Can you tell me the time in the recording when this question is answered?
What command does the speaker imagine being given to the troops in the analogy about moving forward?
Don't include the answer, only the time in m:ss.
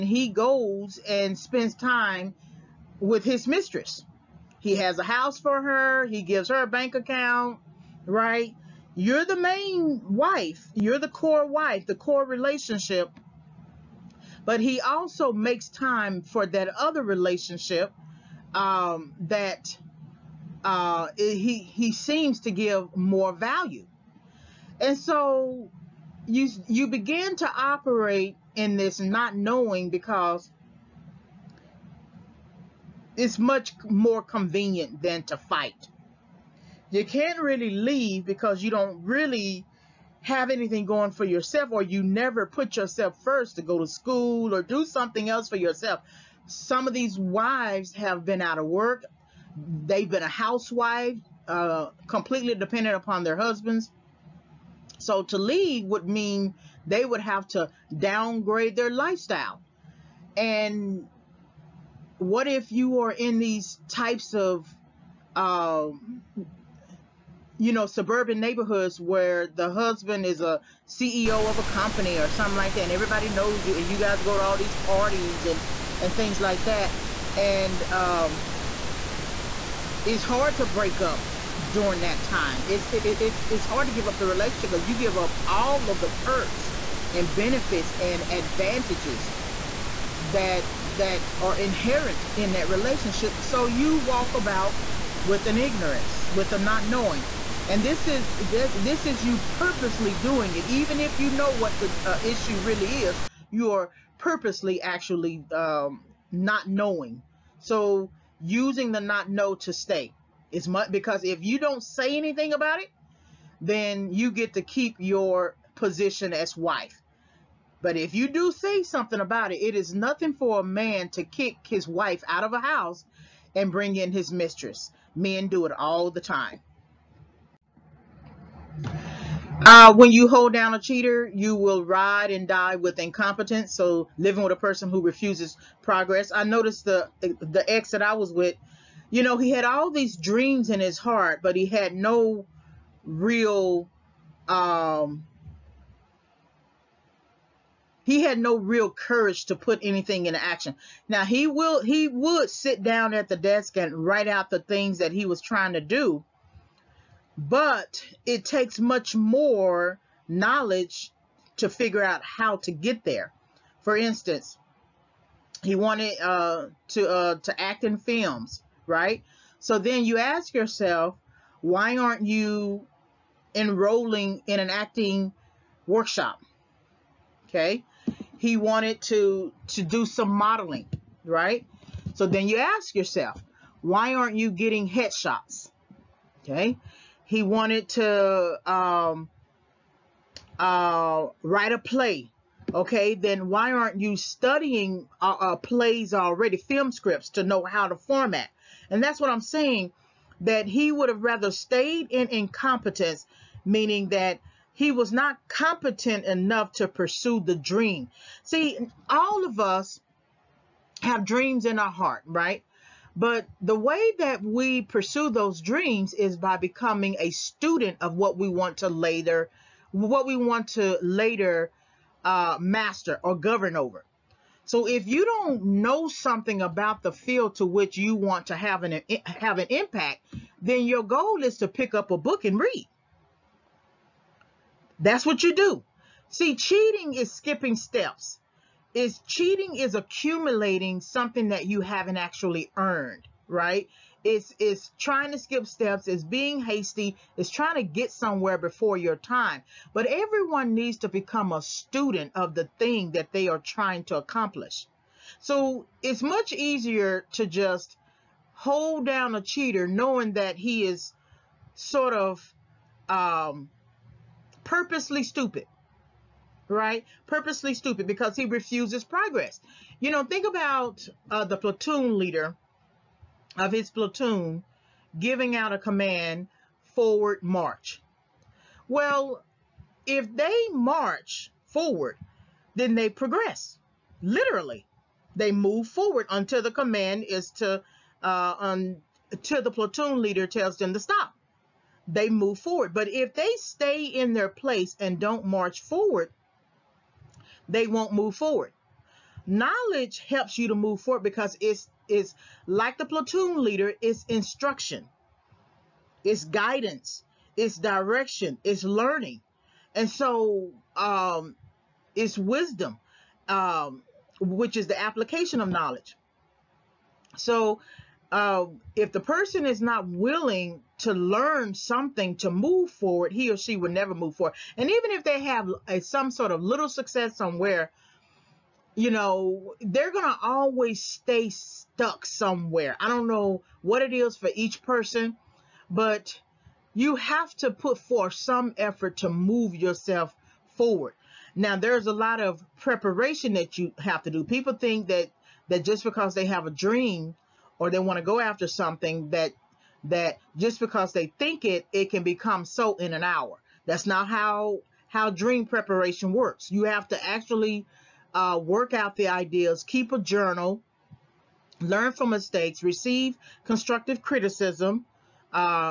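4:36.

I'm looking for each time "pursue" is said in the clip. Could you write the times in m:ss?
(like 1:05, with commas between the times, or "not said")
3:26, 3:34.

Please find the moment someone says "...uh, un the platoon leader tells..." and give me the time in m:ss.
4:48.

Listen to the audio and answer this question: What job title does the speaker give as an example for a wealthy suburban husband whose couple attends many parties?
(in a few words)
CEO.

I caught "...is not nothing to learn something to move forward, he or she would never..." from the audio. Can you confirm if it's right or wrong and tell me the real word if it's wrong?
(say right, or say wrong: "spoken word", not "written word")
wrong: "willing", not "nothing".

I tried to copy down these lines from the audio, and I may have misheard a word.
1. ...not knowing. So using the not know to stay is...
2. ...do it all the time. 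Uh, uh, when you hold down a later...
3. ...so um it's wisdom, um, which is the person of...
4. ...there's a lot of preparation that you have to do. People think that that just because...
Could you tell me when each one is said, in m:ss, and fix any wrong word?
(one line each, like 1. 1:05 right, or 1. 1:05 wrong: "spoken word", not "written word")
1. 1:46 right
2. 2:05 wrong: "cheater", not "later"
3. 5:10 wrong: "application", not "person"
4. 5:41 right.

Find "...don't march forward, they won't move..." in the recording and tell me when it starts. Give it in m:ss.
4:55.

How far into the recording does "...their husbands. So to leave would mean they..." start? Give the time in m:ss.
0:53.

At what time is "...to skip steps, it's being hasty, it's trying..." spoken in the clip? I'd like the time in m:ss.
4:05.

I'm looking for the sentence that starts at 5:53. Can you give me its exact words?
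That's not how how dream preparation works.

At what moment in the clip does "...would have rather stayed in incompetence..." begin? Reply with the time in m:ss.
3:20.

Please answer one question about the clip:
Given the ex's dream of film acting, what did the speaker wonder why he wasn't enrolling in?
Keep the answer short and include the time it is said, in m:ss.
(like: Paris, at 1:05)
an acting workshop, at 2:54.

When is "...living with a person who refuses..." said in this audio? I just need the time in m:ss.
2:14.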